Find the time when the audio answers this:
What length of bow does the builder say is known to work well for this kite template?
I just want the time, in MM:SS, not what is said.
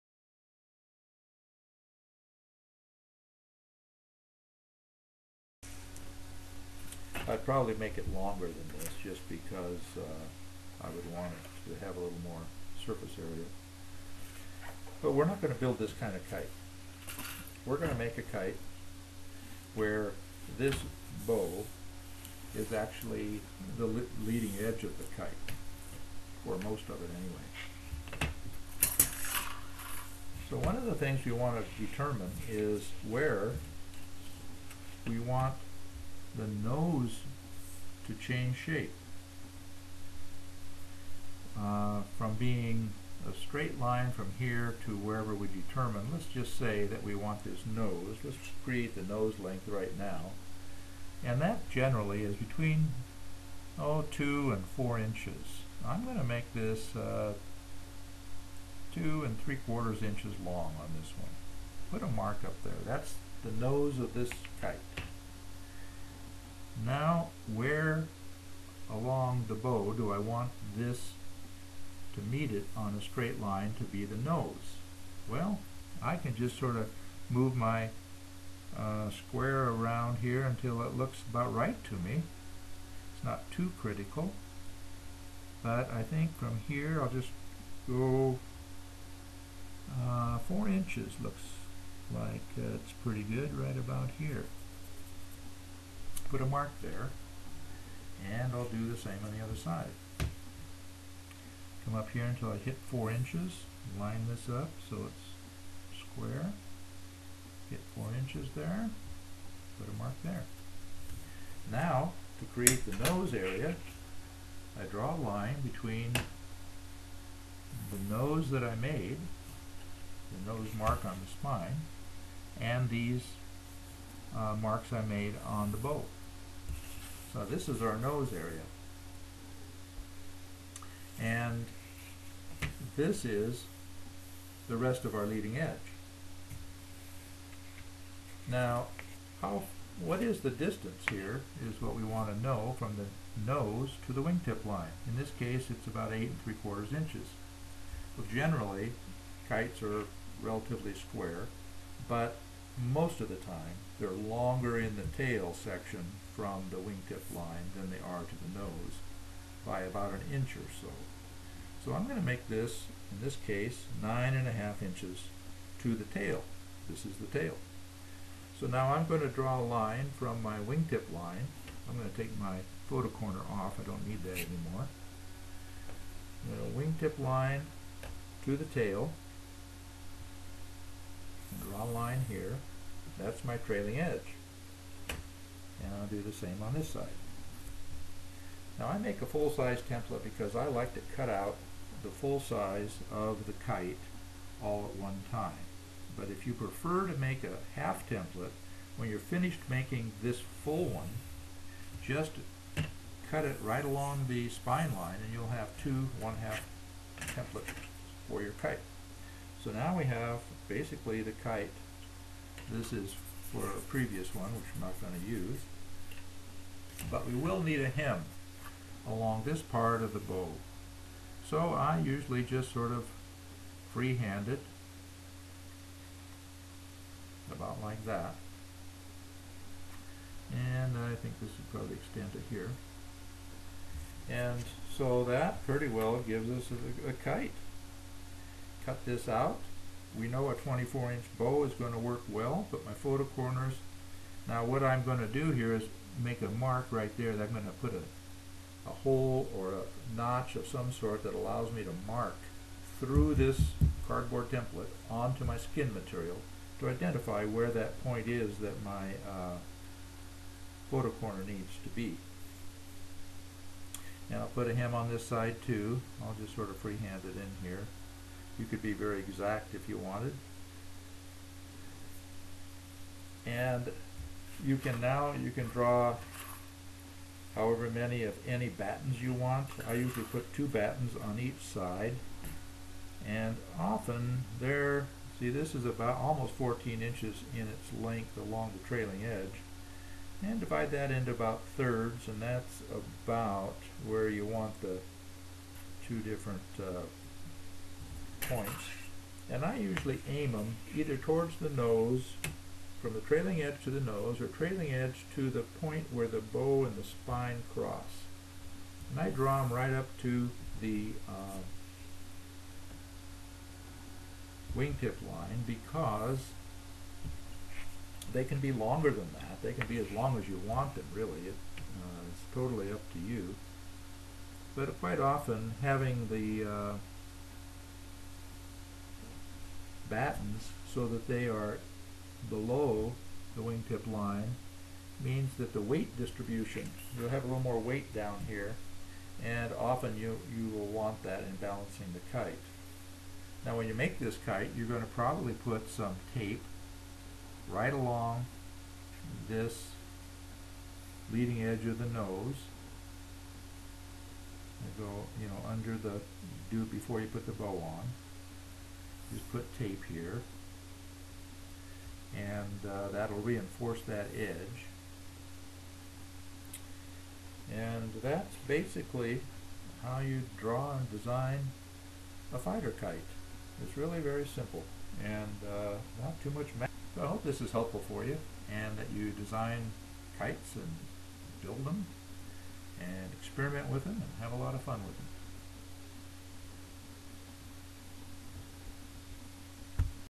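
04:00.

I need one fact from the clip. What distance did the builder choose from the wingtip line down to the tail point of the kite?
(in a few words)
9 1/2 inches.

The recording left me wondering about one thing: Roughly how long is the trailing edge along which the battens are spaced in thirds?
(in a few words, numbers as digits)
almost 14 inches.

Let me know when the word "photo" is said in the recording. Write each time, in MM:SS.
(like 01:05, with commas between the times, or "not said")
02:52, 04:02, 04:20.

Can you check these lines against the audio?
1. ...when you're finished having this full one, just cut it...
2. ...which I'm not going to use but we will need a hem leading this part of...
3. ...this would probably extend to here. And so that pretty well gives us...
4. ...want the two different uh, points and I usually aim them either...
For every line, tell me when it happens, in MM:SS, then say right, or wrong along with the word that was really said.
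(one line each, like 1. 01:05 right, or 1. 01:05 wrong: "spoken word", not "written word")
1. 03:18 wrong: "making", not "having"
2. 03:34 wrong: "along", not "leading"
3. 03:51 right
4. 04:54 right.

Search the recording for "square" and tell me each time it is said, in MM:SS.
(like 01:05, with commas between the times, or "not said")
01:19, 01:45, 02:30.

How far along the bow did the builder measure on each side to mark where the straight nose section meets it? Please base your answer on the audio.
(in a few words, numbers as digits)
4 inches.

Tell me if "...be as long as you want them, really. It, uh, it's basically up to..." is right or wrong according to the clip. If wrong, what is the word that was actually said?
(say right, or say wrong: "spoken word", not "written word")
wrong: "totally", not "basically".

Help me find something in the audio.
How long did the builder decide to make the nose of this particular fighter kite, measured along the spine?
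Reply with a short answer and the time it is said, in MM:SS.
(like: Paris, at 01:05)
2 3/4 inches, at 00:58.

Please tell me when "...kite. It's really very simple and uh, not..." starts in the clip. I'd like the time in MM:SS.
06:12.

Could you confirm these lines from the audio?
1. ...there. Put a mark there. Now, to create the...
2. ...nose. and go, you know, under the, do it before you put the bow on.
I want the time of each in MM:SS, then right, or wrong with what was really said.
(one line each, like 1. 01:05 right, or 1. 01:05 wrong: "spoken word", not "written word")
1. 01:48 right
2. 05:52 right.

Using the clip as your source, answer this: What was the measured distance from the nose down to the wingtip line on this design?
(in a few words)
8 3/4 inches.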